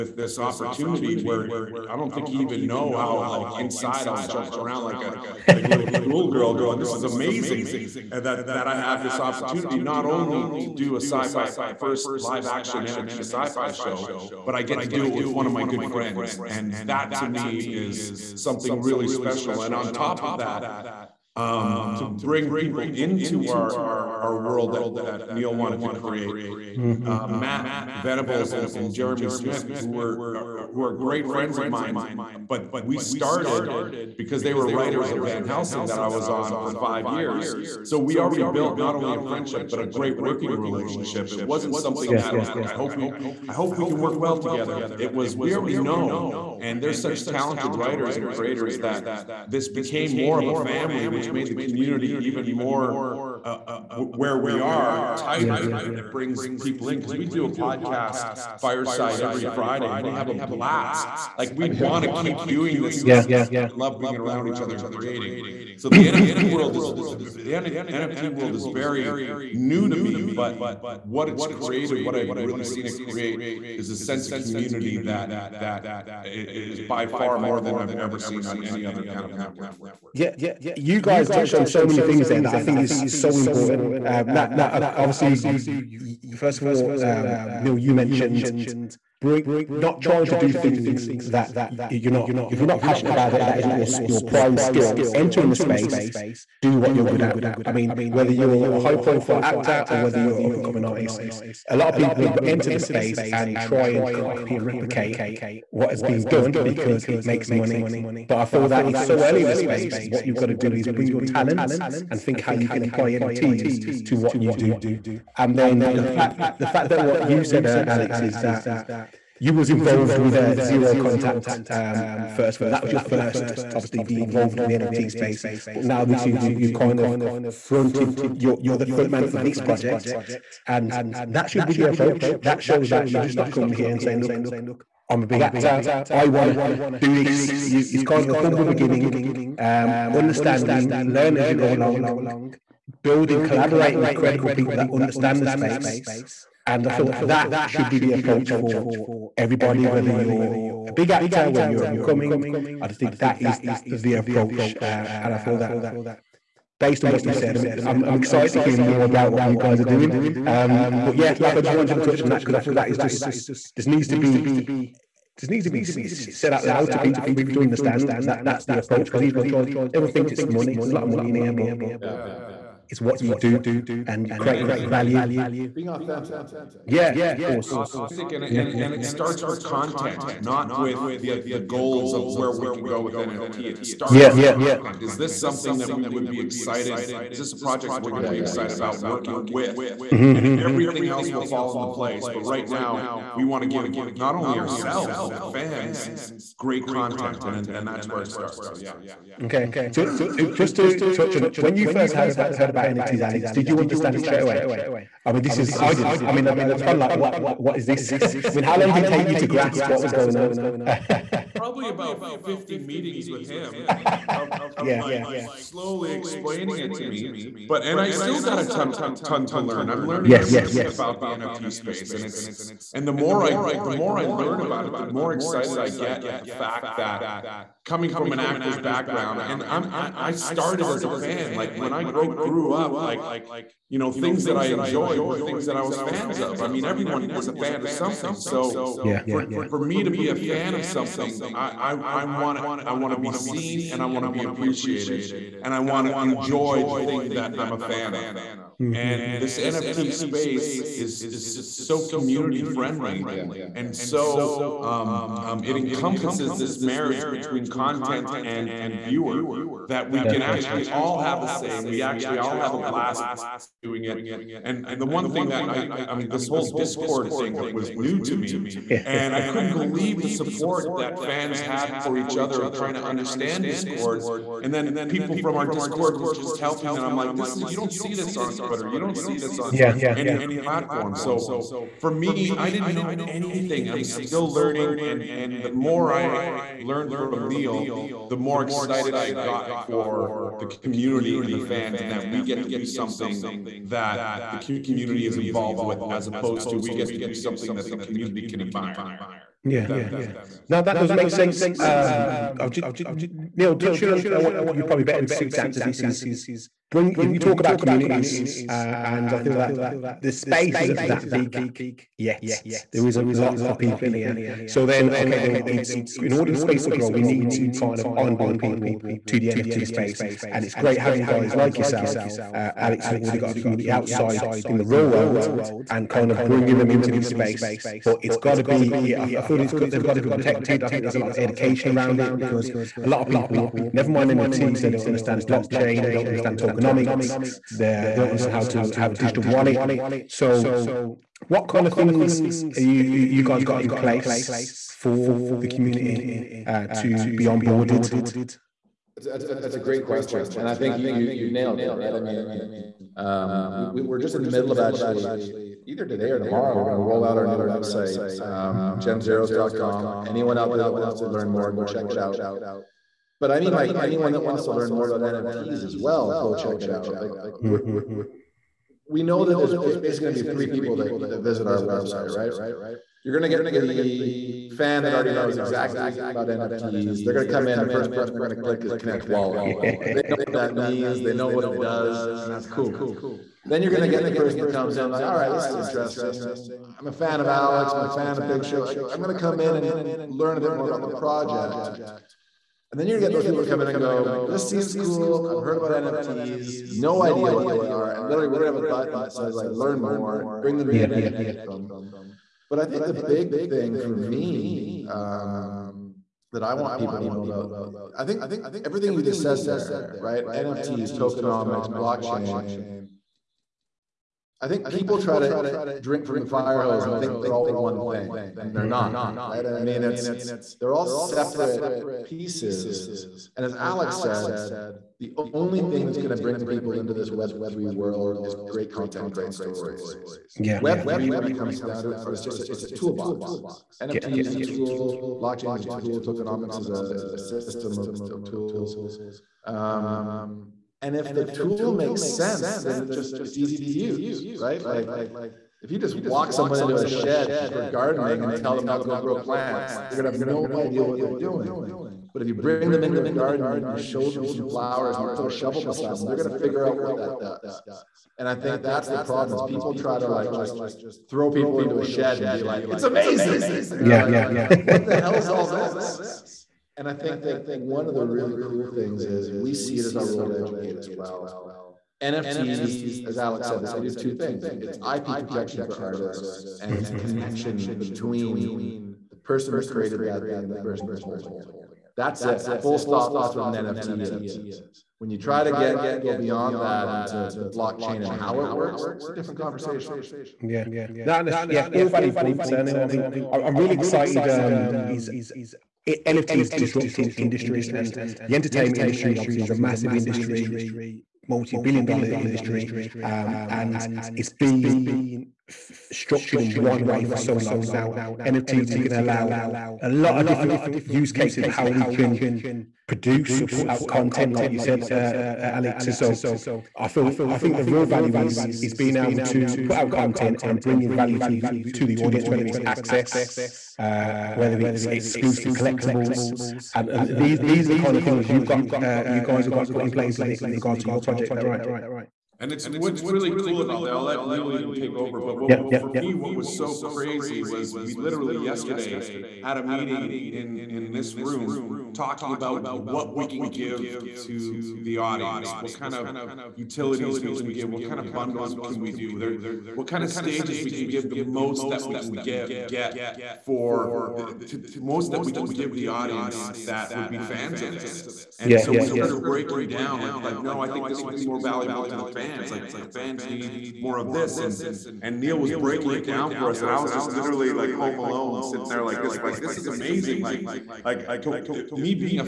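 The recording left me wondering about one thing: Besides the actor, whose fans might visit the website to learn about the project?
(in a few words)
Big Show.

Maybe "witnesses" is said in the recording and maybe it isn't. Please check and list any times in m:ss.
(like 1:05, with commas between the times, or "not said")
not said.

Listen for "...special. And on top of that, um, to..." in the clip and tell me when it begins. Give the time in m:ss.
0:19.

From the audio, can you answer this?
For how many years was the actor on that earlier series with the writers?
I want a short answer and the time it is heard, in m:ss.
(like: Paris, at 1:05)
5, at 0:36.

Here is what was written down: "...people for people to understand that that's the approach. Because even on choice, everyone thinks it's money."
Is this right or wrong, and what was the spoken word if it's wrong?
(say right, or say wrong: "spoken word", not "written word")
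right.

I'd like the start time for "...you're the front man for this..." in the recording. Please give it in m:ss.
2:08.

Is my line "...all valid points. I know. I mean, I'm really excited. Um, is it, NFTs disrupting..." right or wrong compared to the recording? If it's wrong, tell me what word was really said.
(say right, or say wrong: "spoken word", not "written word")
right.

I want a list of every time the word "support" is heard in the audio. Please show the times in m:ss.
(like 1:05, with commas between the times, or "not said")
4:30.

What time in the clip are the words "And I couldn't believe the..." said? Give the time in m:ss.
4:29.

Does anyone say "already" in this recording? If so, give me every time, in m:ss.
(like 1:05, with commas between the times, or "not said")
0:38, 0:45, 5:23, 6:15.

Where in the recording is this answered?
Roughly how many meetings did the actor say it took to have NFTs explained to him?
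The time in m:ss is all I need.
3:32.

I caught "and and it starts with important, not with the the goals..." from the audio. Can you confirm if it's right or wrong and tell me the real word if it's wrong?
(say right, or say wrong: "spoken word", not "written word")
wrong: "content", not "important".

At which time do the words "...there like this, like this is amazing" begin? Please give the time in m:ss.
9:28.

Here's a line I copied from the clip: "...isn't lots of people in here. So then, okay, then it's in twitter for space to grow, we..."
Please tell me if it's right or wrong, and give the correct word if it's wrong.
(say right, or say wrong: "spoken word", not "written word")
wrong: "order", not "twitter".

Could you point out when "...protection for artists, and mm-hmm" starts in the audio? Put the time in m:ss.
7:55.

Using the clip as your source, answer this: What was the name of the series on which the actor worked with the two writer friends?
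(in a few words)
Van Helsing.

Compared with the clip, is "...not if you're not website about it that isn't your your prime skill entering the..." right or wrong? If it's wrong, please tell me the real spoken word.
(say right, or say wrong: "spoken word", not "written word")
wrong: "passionate", not "website".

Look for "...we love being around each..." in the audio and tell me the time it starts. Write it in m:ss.
1:03.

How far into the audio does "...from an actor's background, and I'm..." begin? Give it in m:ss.
3:48.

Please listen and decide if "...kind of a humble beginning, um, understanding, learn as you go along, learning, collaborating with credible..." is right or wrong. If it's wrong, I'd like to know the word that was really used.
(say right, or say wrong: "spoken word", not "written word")
wrong: "building", not "learning".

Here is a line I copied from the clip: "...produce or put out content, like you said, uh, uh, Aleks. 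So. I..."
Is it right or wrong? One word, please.
right.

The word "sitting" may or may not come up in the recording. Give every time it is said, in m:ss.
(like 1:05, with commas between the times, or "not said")
9:28.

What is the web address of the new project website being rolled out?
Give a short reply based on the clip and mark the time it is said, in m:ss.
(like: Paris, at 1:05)
genzeroes.com, at 5:58.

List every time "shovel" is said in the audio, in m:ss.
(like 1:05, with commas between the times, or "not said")
7:35.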